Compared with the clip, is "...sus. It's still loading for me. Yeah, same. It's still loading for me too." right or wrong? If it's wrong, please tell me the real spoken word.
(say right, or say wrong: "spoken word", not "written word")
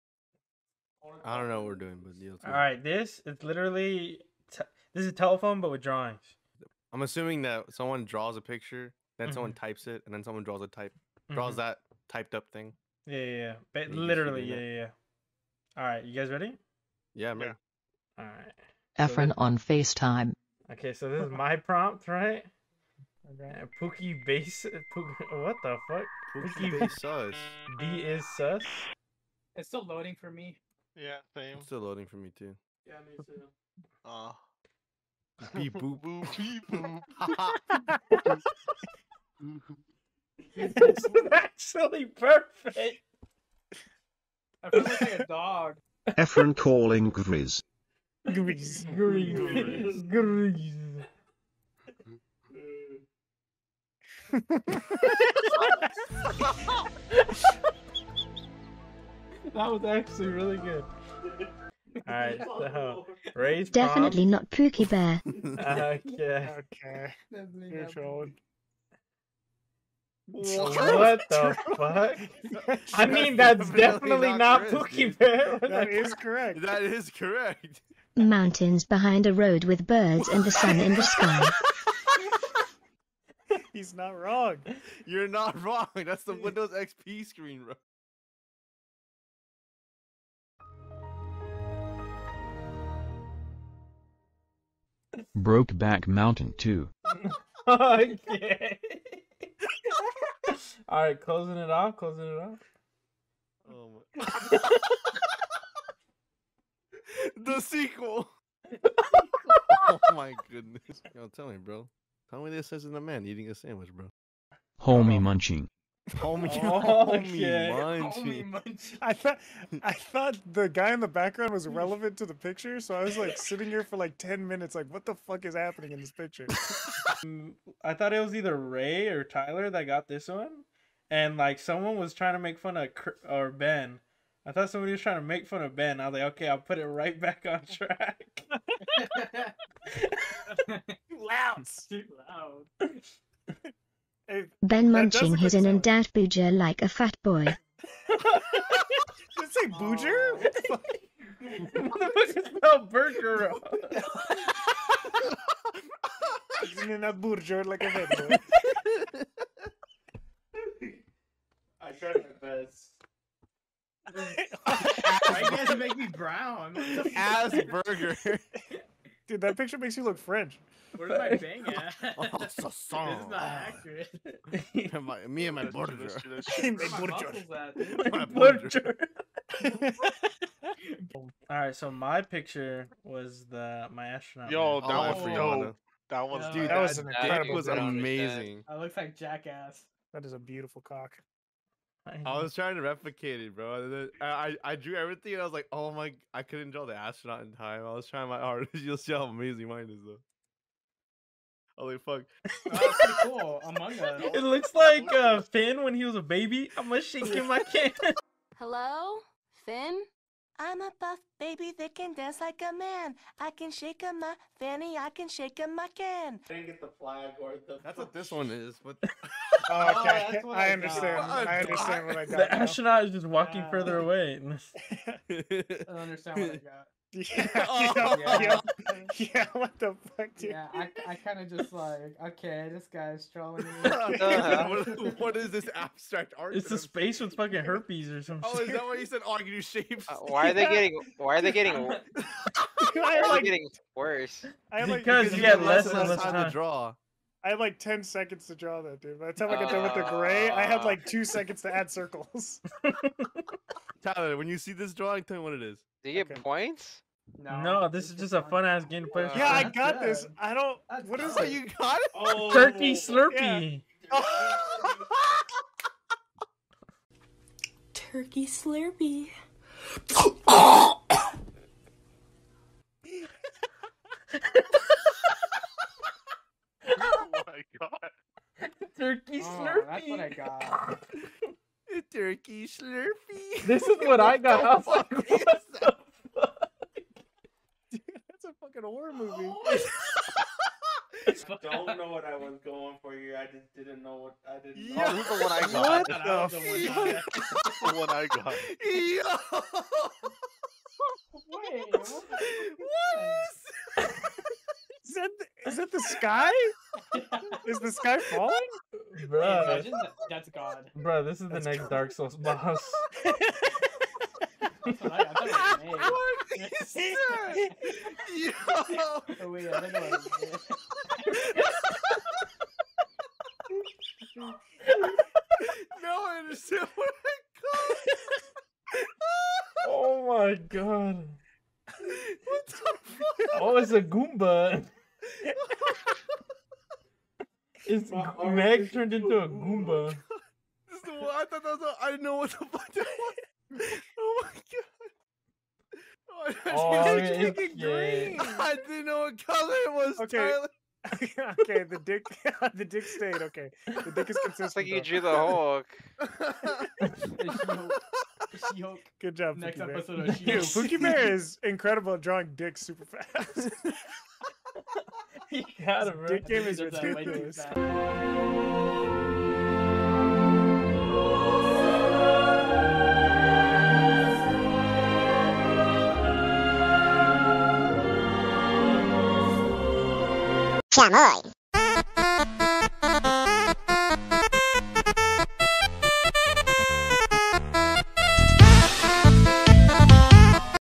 right.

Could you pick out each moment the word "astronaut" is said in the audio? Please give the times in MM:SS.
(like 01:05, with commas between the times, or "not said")
03:04, 03:16, 03:42.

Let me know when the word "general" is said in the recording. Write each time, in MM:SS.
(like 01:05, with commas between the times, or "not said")
not said.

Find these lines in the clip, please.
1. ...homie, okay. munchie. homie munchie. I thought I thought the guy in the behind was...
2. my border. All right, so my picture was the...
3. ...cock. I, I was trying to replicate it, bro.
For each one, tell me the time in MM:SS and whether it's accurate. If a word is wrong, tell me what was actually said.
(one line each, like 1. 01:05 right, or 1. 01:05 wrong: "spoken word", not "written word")
1. 01:57 wrong: "background", not "behind"
2. 02:58 right
3. 03:10 right.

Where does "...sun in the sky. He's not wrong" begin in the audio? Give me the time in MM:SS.
01:20.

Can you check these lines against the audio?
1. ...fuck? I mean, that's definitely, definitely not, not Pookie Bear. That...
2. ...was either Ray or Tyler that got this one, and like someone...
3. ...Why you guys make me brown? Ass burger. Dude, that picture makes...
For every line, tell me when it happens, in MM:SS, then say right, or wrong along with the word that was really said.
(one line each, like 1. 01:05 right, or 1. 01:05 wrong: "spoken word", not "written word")
1. 01:11 right
2. 02:08 right
3. 02:44 right.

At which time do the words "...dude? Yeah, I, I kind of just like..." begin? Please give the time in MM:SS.
03:50.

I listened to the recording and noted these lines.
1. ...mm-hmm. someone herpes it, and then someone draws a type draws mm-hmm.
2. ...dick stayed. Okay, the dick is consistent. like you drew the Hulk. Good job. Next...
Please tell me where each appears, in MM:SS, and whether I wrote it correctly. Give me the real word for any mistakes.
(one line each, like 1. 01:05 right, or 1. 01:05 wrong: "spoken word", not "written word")
1. 00:09 wrong: "types", not "herpes"
2. 05:52 right.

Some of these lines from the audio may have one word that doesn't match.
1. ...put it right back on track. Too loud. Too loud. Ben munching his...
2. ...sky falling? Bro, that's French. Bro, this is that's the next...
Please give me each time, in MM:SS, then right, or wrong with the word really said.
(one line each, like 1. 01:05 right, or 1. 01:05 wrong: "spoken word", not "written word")
1. 02:16 right
2. 05:07 wrong: "God", not "French".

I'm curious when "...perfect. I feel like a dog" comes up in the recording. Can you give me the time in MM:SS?
00:42.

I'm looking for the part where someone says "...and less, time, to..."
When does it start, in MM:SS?
04:05.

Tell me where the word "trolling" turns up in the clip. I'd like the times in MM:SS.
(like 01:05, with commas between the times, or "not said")
01:07, 03:53.